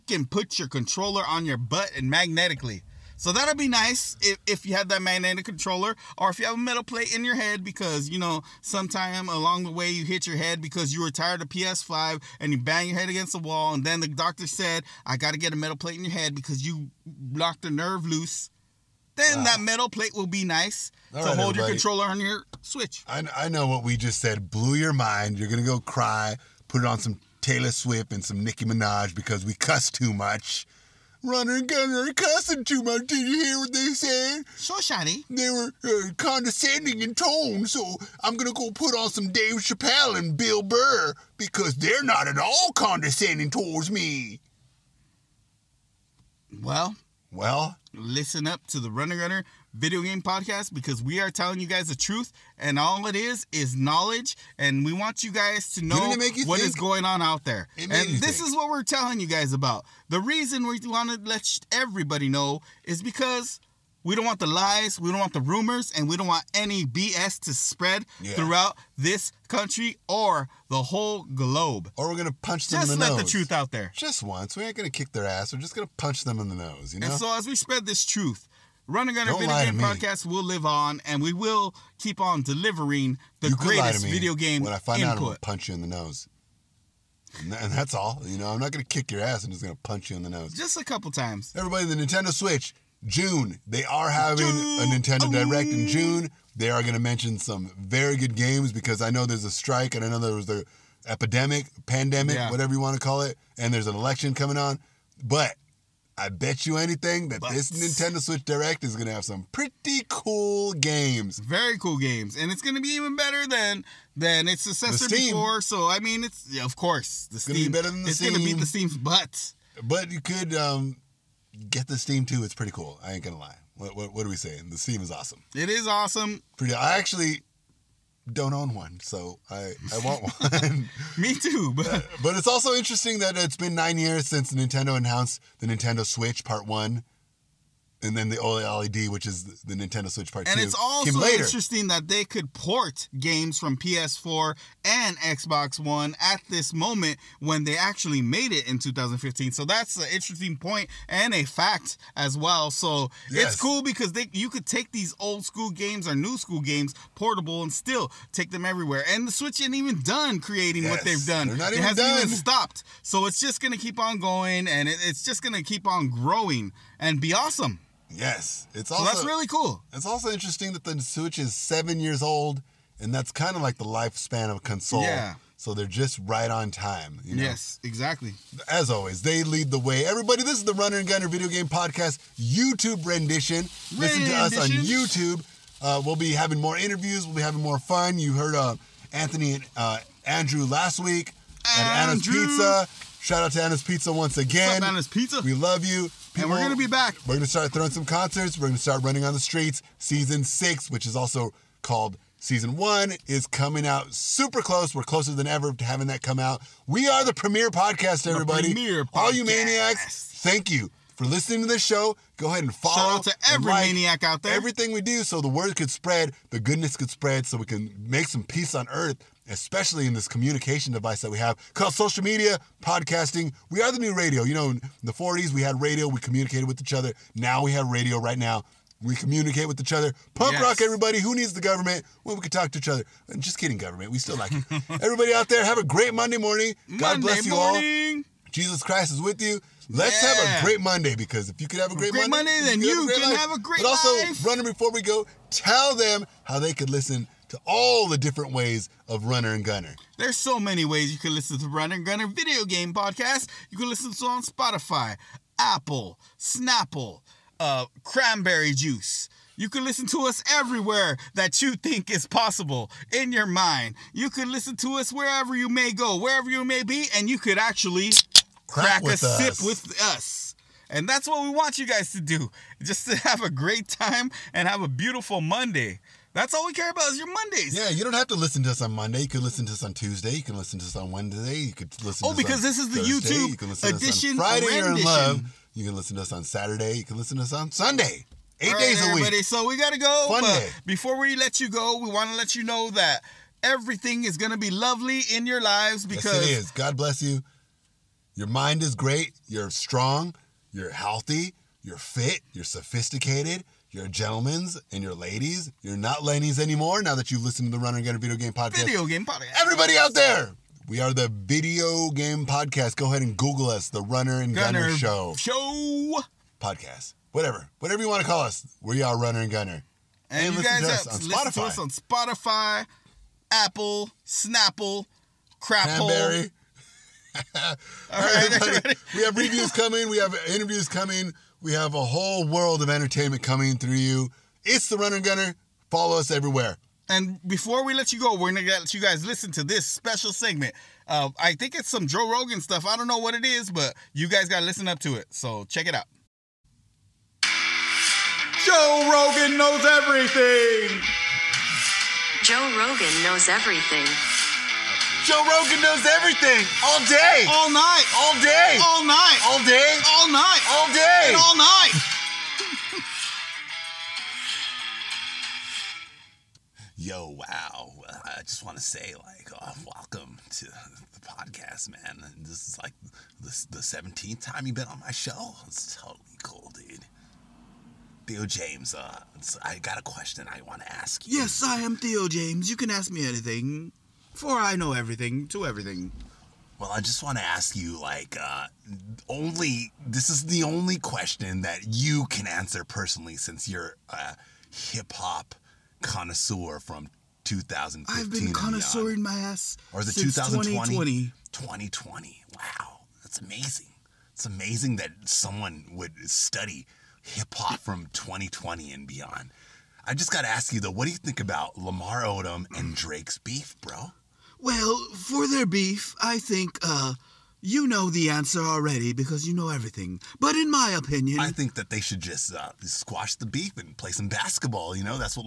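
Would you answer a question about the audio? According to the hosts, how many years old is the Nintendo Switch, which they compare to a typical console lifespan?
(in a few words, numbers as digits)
7.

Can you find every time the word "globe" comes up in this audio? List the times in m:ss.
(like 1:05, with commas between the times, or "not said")
1:11.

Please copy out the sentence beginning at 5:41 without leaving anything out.
Uh, I think it's some Joe Rogan stuff.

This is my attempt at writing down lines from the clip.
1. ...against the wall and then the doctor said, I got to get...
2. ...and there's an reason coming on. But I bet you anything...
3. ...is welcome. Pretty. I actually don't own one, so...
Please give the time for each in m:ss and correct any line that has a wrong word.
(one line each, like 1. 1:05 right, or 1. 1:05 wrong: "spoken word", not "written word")
1. 0:13 right
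2. 1:43 wrong: "election", not "reason"
3. 2:05 wrong: "awesome", not "welcome".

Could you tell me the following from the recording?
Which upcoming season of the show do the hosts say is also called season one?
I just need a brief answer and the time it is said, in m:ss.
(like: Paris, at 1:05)
Season 6, at 3:19.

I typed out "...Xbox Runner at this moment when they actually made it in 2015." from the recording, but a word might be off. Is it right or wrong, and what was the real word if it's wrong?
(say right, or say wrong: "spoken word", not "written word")
wrong: "One", not "Runner".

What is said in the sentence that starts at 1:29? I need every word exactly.
I'm just going to punch you in the nose.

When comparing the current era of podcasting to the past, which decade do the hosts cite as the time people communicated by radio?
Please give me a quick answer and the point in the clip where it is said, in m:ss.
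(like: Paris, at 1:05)
40s, at 3:45.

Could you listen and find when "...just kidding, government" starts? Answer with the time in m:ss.
3:53.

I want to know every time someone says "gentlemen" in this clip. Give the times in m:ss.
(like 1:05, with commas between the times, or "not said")
5:04.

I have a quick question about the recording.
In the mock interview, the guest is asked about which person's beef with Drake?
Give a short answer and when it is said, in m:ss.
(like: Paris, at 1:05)
Lamar Odom, at 6:51.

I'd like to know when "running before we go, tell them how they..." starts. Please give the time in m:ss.
4:04.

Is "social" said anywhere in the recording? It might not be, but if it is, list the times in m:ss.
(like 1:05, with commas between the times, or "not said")
3:41.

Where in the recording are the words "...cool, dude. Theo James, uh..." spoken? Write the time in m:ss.
6:16.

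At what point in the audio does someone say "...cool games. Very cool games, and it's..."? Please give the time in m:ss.
1:50.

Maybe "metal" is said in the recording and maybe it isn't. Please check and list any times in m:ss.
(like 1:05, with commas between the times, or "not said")
0:06, 0:15, 0:19.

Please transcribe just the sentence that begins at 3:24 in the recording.
We're closer than ever to having that come out.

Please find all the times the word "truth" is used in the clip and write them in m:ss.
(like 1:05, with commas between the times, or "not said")
0:51, 1:13, 1:18.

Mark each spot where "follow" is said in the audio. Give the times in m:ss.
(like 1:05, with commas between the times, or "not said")
3:32, 5:35.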